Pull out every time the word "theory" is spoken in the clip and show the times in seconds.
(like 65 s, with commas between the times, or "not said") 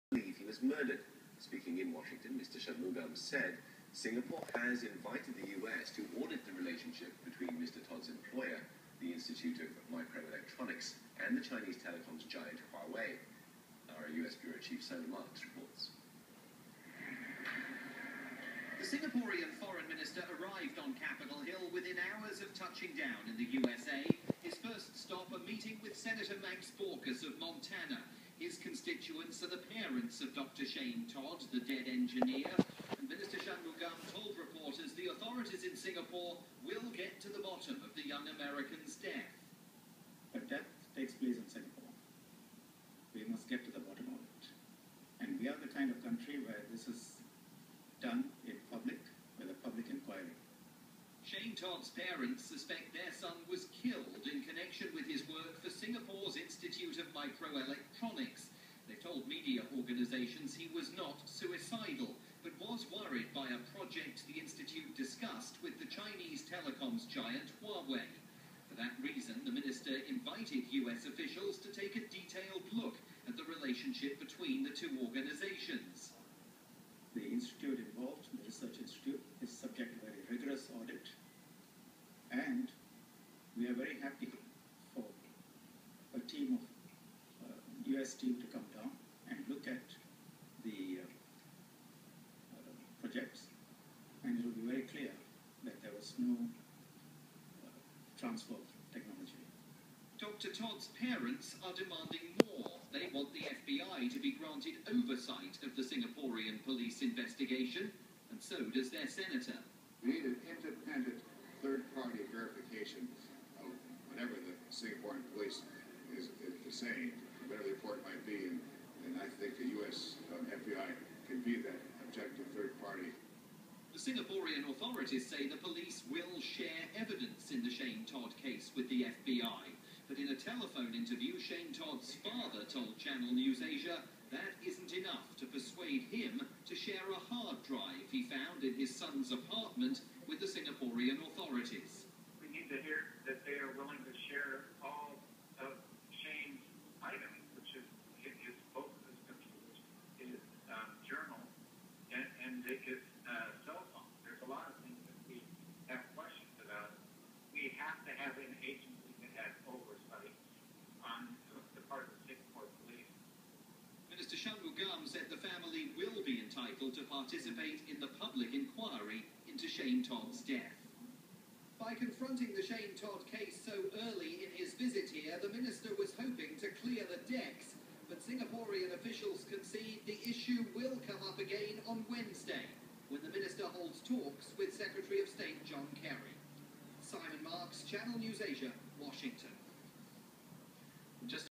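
not said.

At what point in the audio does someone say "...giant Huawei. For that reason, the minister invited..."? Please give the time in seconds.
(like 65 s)
67 s.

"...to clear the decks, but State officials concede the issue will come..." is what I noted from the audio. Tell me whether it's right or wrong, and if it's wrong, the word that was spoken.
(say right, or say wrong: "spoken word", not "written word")
wrong: "Singaporean", not "State".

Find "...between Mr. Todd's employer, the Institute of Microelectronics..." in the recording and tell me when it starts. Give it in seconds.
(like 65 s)
7 s.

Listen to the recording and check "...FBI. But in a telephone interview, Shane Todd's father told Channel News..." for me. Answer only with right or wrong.
right.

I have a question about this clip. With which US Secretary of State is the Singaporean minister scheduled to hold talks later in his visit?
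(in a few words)
John Kerry.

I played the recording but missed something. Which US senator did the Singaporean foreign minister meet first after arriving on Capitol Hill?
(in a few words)
Max Baucus.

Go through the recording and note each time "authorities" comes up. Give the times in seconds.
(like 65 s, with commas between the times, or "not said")
35 s, 124 s, 141 s.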